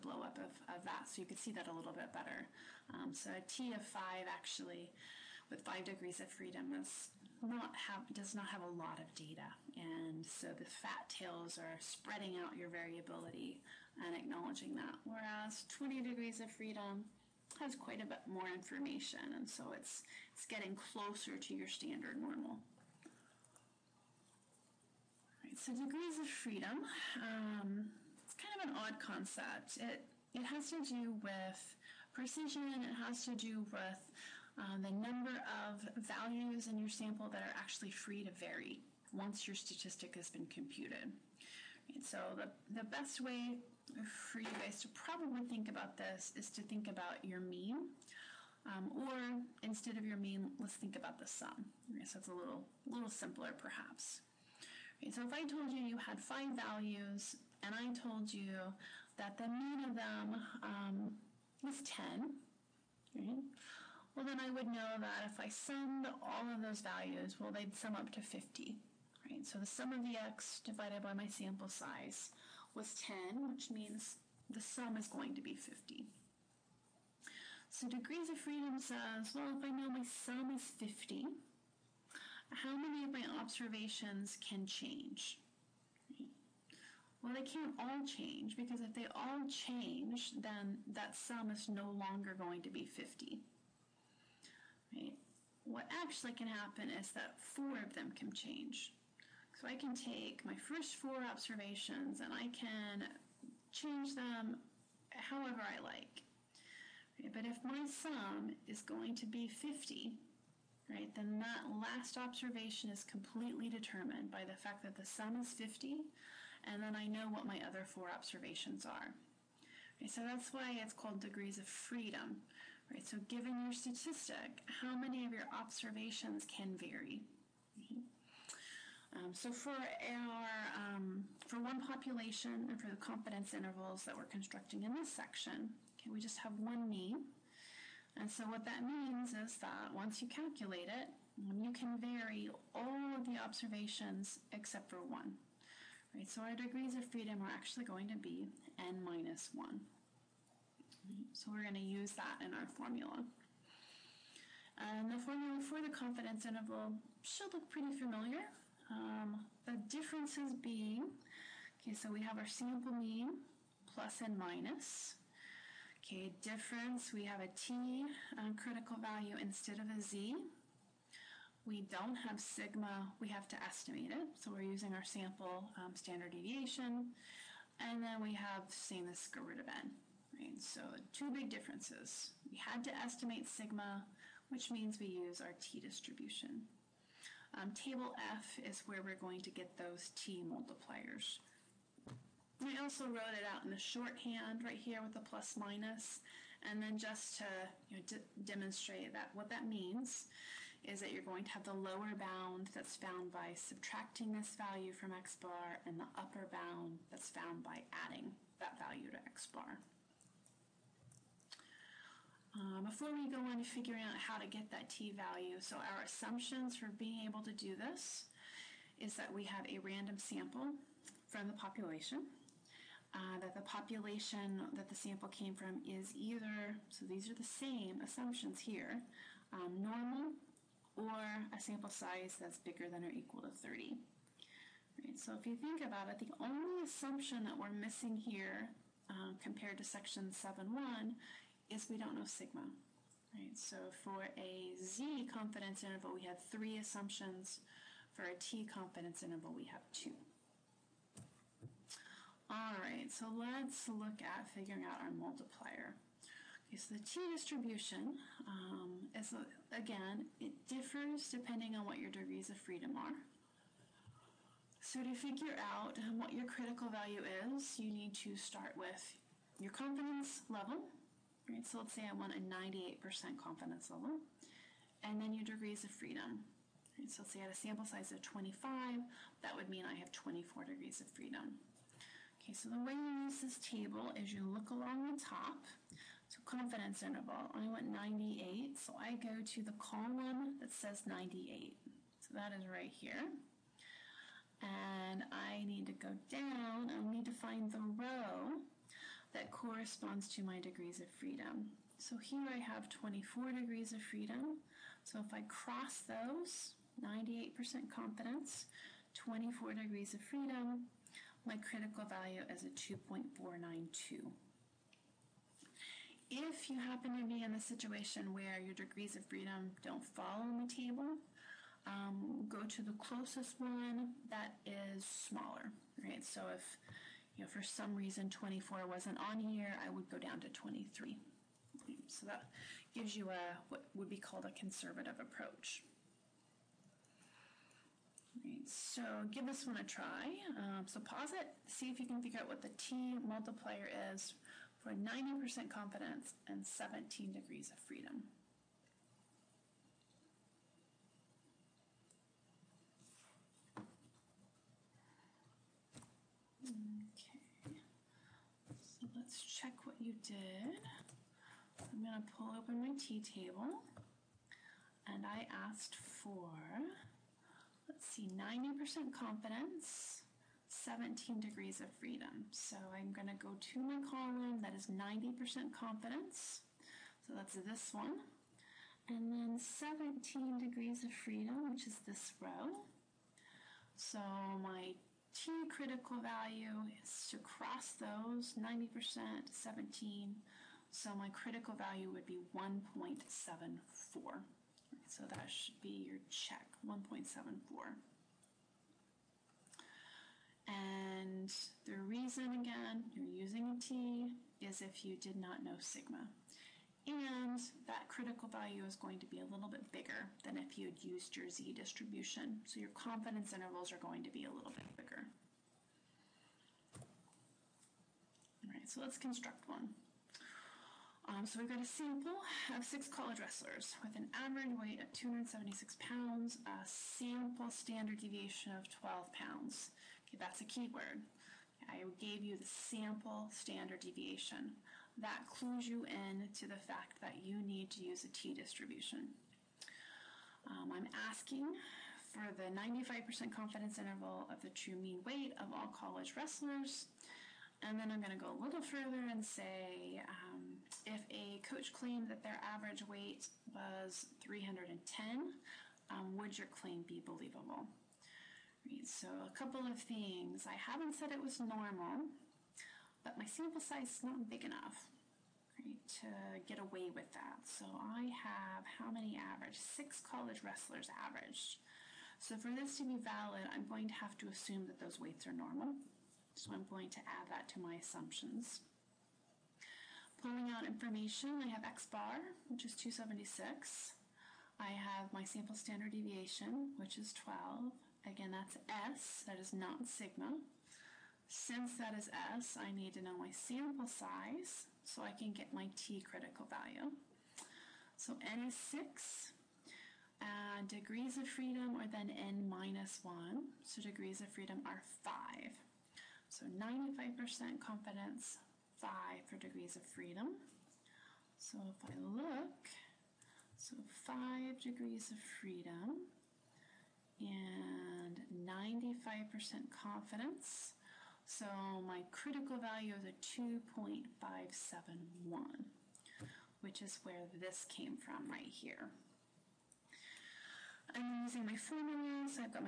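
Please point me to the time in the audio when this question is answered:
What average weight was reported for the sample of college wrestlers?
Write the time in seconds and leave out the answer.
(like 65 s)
425 s.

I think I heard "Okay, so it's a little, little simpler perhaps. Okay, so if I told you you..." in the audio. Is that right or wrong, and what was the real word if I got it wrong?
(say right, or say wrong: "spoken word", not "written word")
right.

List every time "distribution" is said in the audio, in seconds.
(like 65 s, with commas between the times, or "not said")
185 s, 257 s, 411 s, 438 s.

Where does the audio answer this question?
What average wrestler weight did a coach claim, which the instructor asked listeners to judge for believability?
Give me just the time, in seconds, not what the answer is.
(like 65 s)
454 s.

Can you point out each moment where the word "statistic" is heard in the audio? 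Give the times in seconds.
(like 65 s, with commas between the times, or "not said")
39 s, 123 s.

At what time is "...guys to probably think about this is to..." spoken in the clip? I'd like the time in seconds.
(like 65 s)
44 s.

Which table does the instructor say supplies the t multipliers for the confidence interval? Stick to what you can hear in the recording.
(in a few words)
Table F.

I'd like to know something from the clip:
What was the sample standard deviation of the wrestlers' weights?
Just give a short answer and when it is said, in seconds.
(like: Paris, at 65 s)
12 pounds, at 428 s.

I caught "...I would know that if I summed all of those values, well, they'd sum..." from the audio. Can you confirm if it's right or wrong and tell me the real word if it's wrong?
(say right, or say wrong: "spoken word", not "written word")
right.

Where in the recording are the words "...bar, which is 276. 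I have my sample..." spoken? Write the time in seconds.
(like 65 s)
482 s.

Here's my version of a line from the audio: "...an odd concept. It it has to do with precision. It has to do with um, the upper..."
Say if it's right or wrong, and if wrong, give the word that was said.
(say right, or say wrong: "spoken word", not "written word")
wrong: "number", not "upper".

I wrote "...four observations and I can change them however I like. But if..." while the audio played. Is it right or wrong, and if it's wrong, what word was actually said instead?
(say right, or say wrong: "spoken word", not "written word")
right.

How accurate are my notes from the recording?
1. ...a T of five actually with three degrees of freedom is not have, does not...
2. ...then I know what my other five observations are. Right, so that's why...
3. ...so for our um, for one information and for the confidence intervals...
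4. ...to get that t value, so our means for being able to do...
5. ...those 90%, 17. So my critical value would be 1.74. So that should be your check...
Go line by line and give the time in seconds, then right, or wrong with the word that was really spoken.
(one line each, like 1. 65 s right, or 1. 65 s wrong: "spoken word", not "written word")
1. 3 s wrong: "five", not "three"
2. 116 s wrong: "four", not "five"
3. 129 s wrong: "population", not "information"
4. 214 s wrong: "assumptions", not "means"
5. 387 s right.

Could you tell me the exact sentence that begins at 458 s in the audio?
Right, so, a couple of things.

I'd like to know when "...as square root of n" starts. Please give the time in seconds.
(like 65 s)
179 s.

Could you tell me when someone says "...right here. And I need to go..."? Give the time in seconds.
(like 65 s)
292 s.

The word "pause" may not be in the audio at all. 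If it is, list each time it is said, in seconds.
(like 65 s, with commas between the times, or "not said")
340 s.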